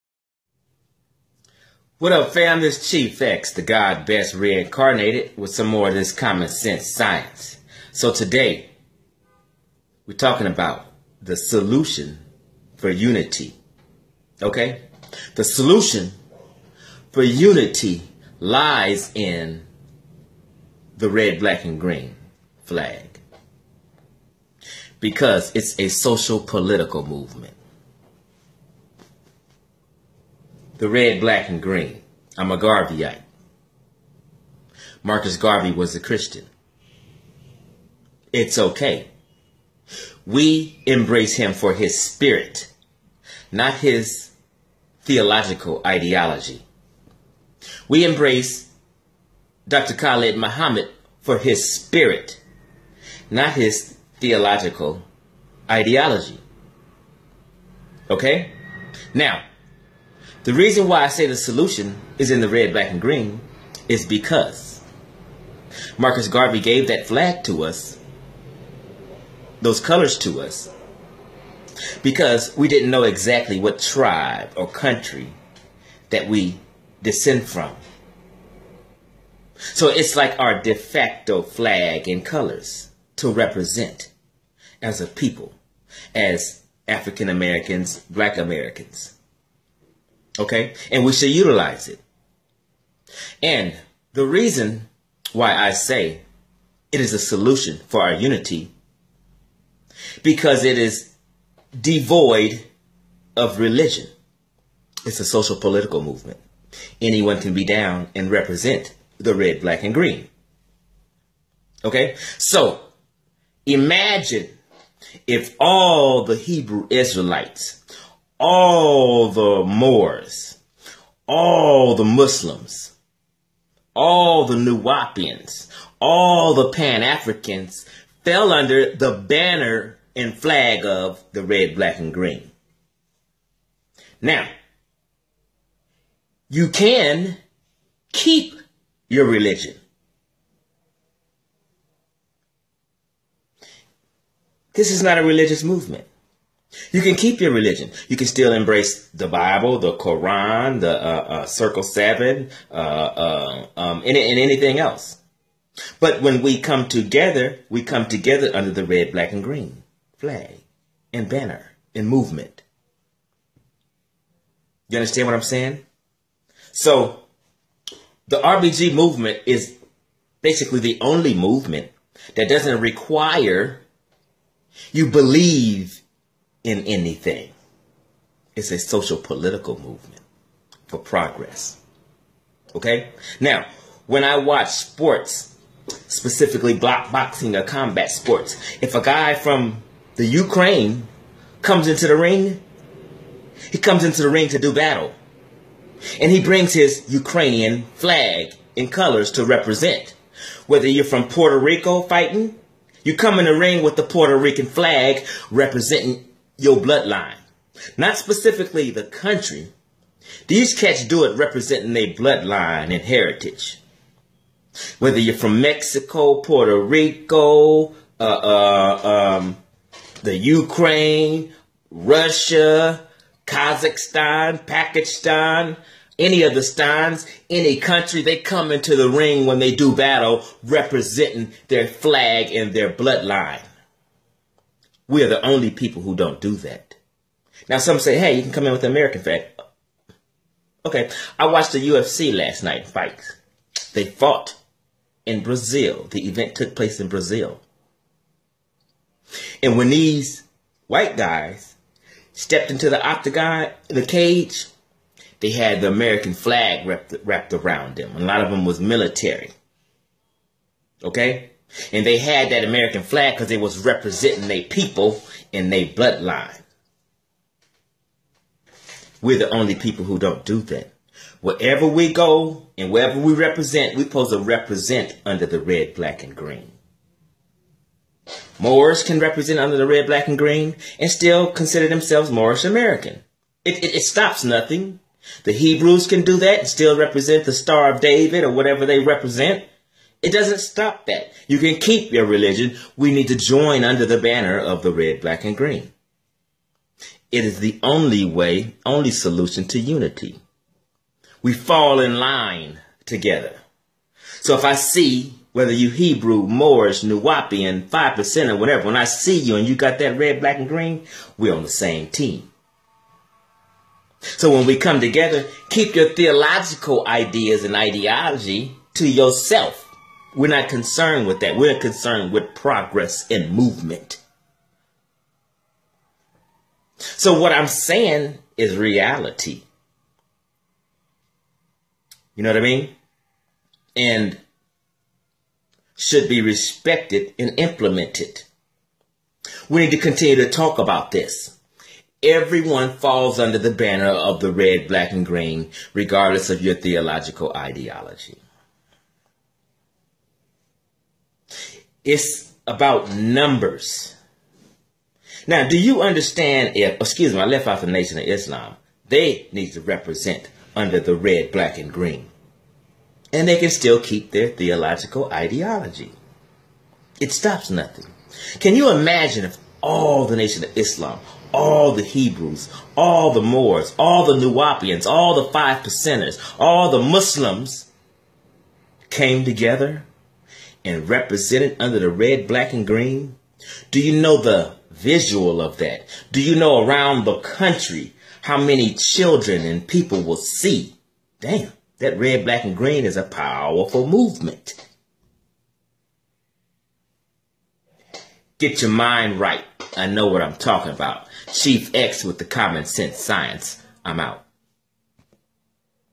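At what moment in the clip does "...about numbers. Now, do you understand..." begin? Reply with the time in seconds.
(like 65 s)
352 s.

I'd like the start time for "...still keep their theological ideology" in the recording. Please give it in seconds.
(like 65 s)
363 s.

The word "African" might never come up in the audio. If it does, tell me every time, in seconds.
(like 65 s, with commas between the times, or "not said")
86 s, 127 s.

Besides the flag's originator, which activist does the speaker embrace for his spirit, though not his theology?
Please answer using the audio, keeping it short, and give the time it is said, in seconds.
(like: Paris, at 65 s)
Khalid Muhammad, at 49 s.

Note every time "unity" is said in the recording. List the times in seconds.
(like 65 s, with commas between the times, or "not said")
12 s, 17 s, 98 s, 299 s.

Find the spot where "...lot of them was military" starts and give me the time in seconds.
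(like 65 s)
258 s.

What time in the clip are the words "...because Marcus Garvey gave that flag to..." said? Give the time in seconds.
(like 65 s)
64 s.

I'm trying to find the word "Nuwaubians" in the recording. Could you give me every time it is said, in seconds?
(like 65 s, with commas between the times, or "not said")
124 s, 307 s, 374 s.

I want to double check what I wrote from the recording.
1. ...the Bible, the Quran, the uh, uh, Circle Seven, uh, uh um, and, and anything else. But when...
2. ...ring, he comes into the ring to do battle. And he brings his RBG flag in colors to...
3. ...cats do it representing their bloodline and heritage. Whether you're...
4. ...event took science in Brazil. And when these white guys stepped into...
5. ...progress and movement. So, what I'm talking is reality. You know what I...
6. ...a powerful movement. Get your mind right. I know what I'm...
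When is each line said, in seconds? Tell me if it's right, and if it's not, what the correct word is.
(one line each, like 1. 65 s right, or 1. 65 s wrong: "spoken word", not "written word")
1. 149 s right
2. 192 s wrong: "Ukrainian", not "RBG"
3. 210 s right
4. 246 s wrong: "place", not "science"
5. 322 s wrong: "saying", not "talking"
6. 393 s right.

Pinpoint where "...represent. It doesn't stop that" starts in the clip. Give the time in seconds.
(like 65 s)
288 s.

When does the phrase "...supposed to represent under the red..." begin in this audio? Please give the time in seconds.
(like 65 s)
274 s.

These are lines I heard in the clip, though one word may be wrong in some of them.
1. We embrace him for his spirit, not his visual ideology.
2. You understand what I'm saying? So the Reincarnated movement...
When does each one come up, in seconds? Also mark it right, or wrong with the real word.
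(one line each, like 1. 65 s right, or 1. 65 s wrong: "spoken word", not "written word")
1. 40 s wrong: "theological", not "visual"
2. 164 s wrong: "RBG", not "Reincarnated".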